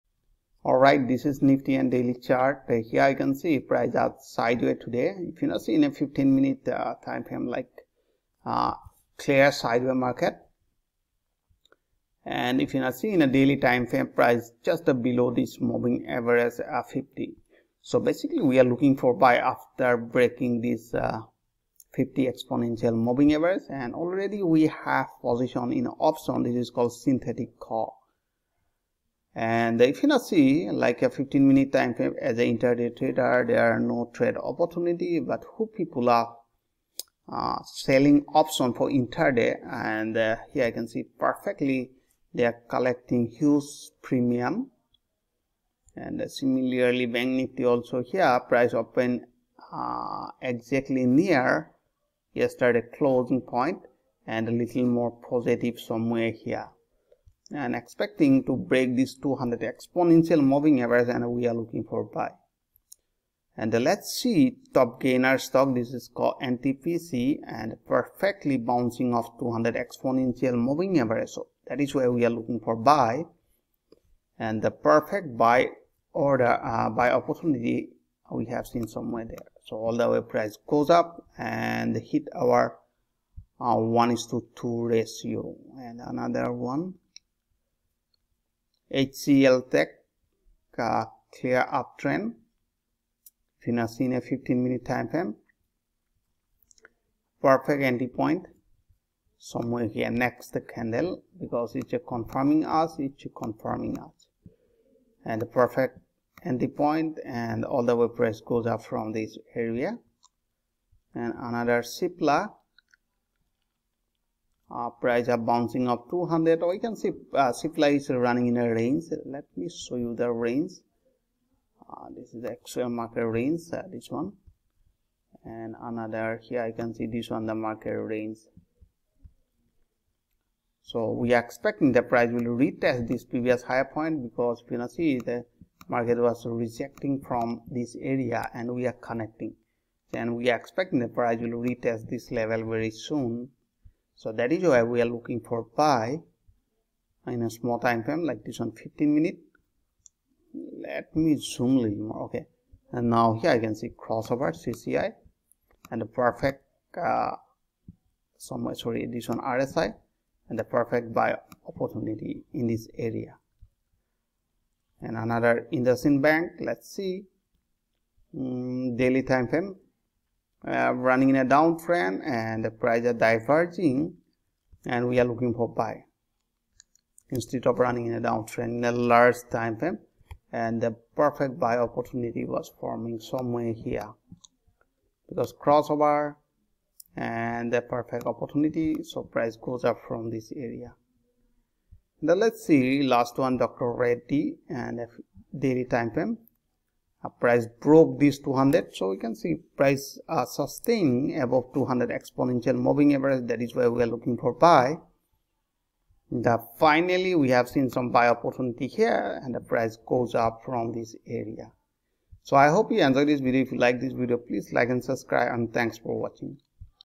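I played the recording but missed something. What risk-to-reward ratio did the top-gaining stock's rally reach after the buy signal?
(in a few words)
1:2.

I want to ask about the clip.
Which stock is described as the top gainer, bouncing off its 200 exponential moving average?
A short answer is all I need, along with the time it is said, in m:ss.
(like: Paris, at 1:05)
NTPC, at 1:06.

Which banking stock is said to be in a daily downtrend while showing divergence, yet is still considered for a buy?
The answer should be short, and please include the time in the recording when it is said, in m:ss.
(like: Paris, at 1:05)
IndusInd Bank, at 2:45.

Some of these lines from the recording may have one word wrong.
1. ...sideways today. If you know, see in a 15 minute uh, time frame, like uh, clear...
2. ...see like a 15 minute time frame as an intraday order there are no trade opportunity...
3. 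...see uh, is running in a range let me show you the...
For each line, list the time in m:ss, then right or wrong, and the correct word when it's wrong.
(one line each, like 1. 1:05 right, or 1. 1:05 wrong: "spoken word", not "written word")
1. 0:04 right
2. 0:30 wrong: "trader", not "order"
3. 1:56 right.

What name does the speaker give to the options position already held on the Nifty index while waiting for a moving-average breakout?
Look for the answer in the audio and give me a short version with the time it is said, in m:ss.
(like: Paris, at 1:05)
Synthetic call, at 0:26.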